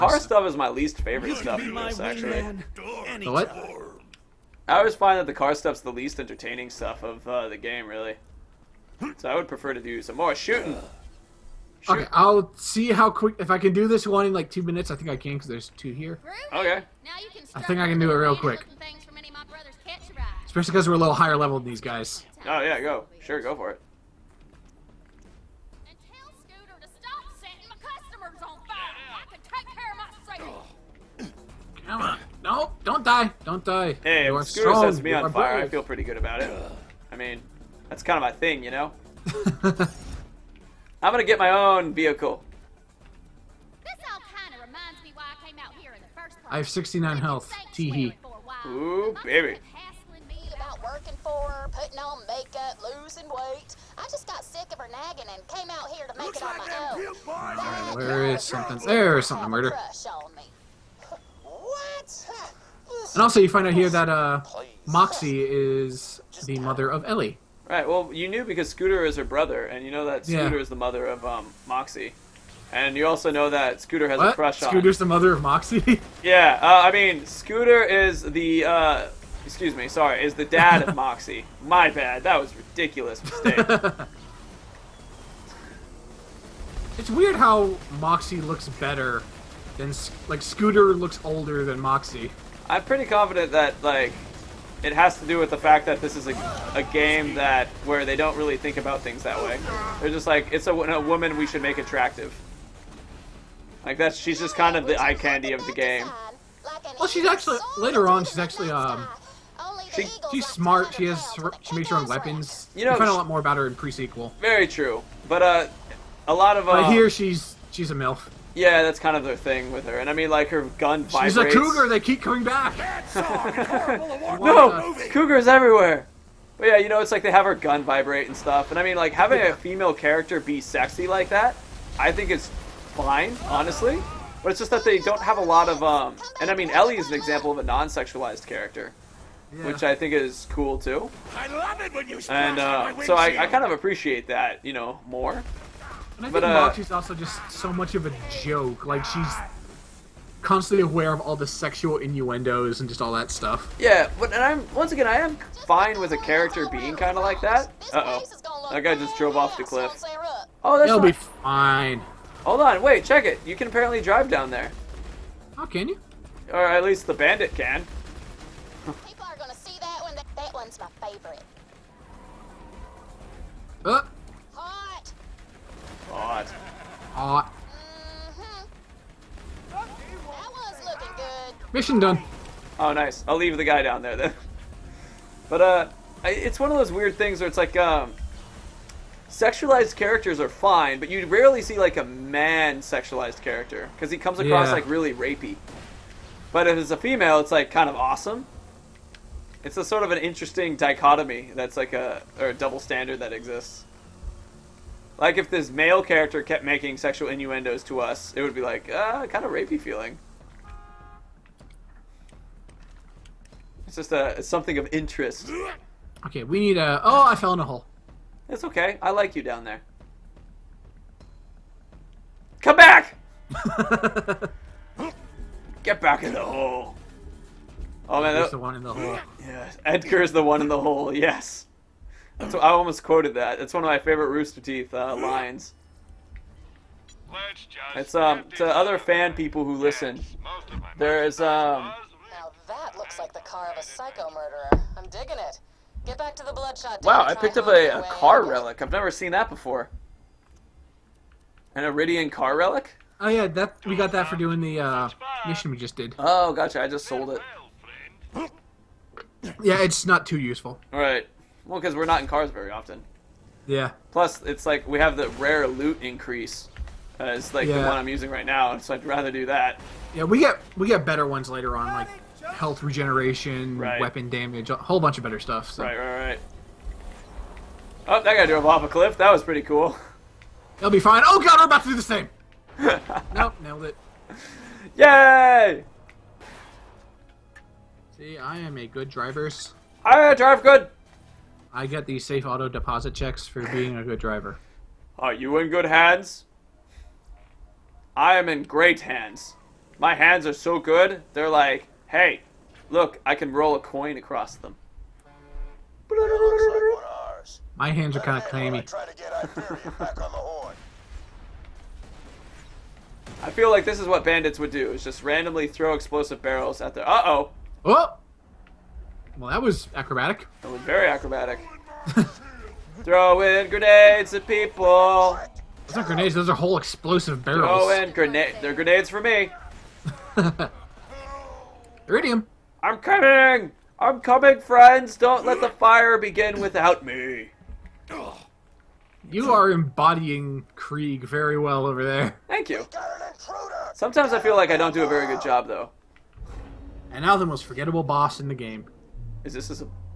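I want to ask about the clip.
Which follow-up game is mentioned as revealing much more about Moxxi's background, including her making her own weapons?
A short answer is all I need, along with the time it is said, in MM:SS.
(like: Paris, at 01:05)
Pre-Sequel, at 01:53.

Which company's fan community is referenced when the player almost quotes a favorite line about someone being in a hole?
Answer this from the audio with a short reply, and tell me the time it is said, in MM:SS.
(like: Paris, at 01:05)
Rooster Teeth, at 03:54.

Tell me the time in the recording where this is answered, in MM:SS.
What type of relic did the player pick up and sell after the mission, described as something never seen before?
04:11.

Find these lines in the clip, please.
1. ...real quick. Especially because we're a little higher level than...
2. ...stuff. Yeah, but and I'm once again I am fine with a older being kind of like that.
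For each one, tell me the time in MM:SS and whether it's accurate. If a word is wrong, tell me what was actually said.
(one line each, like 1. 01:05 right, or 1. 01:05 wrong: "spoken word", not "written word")
1. 00:18 right
2. 02:33 wrong: "character", not "older".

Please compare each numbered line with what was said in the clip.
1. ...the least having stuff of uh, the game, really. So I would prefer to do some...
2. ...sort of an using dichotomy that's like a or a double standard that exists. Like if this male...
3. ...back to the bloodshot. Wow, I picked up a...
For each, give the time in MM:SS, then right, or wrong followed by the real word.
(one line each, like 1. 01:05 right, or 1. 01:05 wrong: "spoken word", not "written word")
1. 00:05 wrong: "entertaining", not "having"
2. 03:19 wrong: "interesting", not "using"
3. 04:06 right.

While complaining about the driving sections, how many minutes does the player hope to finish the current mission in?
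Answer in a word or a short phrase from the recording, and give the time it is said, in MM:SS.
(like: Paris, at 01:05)
2, at 00:14.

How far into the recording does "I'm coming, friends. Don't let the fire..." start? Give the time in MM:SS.
05:34.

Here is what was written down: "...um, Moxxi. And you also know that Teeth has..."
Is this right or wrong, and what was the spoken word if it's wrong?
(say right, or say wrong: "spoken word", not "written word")
wrong: "Scooter", not "Teeth".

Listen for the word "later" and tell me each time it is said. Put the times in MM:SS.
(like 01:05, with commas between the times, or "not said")
01:47, 04:31.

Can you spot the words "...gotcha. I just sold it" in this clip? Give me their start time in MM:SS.
04:16.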